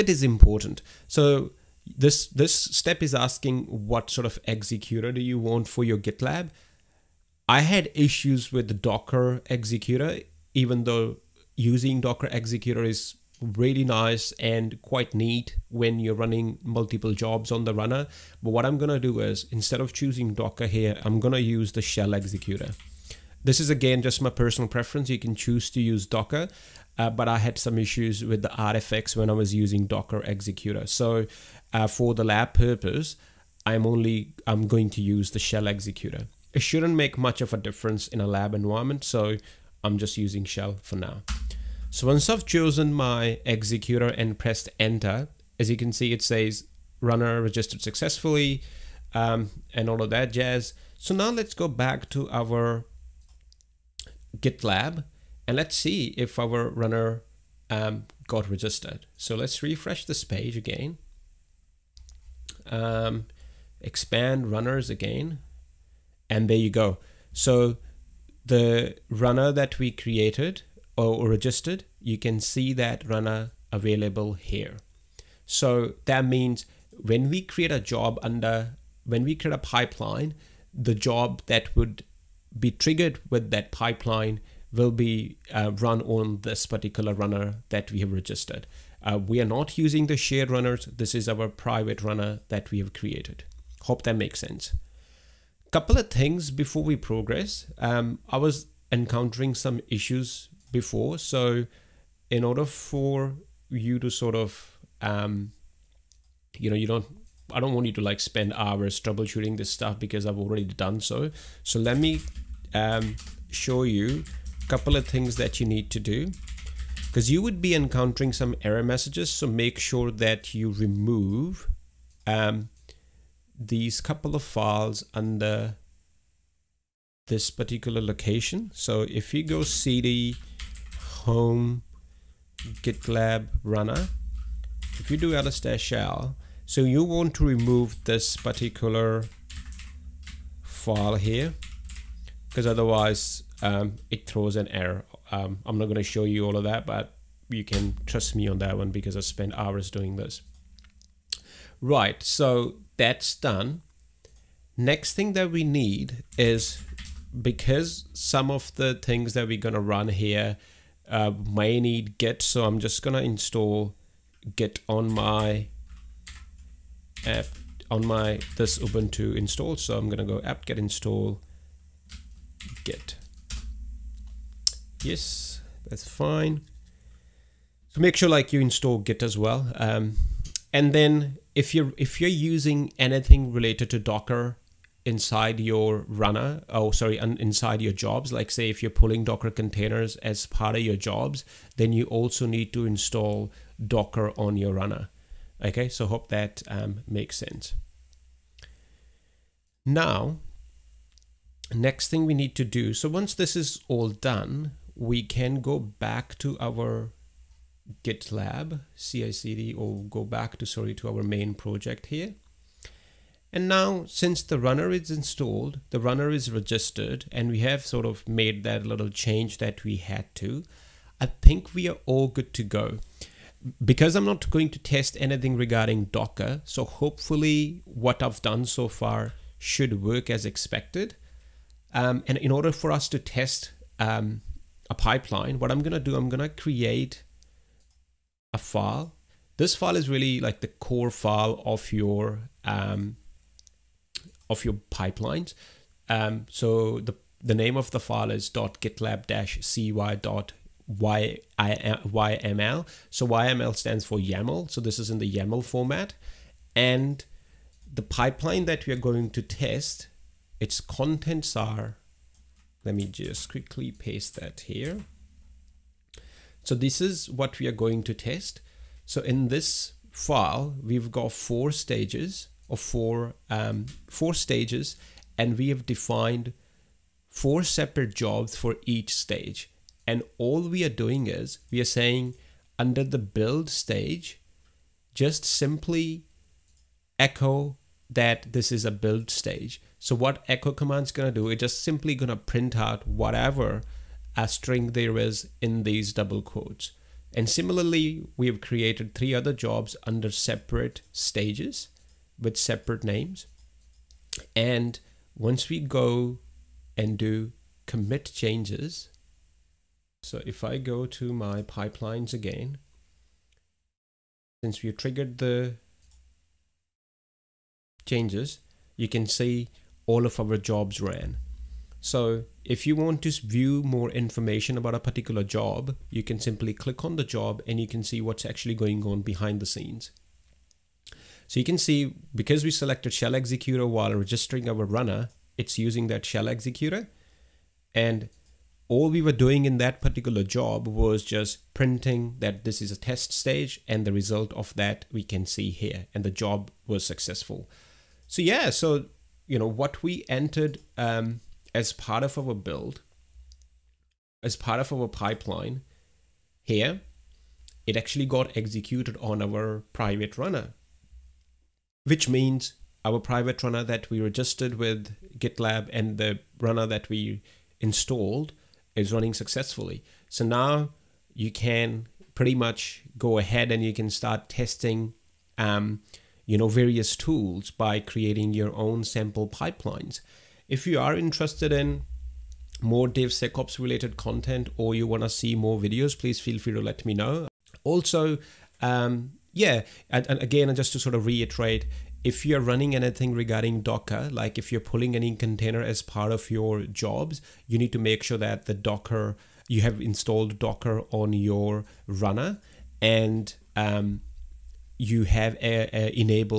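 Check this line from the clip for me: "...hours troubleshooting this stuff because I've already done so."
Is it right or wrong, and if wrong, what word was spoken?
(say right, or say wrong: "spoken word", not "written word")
right.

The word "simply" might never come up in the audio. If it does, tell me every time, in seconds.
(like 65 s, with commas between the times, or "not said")
285 s, 291 s, 326 s.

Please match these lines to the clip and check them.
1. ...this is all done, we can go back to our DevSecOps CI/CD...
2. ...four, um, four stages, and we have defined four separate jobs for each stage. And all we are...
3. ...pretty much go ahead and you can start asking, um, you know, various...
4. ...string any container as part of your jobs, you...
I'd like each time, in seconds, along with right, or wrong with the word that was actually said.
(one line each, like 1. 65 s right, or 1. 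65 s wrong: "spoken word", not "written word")
1. 203 s wrong: "GitLab", not "DevSecOps"
2. 272 s right
3. 372 s wrong: "testing", not "asking"
4. 394 s wrong: "pulling", not "string".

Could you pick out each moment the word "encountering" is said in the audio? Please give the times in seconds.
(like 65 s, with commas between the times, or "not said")
98 s, 117 s.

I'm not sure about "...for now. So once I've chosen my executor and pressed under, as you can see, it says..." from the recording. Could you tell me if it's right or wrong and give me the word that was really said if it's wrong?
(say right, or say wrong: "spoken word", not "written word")
wrong: "enter", not "under".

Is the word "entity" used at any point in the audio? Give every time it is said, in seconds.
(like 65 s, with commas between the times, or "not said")
not said.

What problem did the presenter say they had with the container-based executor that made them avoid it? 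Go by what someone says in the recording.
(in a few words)
artifacts.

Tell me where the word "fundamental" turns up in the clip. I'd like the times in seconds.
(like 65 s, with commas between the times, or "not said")
not said.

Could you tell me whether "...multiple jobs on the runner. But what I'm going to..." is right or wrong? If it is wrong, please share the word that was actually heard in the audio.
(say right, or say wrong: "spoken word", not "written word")
right.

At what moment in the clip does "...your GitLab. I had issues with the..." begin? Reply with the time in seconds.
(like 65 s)
5 s.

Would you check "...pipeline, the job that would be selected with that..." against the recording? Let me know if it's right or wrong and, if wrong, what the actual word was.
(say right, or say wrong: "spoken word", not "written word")
wrong: "triggered", not "selected".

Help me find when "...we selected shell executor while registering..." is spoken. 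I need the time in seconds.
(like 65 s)
332 s.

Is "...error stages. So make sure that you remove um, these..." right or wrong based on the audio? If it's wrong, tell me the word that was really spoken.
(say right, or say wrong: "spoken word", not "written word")
wrong: "messages", not "stages".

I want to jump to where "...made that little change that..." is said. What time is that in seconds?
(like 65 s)
218 s.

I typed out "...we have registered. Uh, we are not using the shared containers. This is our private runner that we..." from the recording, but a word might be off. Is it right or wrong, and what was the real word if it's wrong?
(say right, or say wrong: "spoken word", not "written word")
wrong: "runners", not "containers".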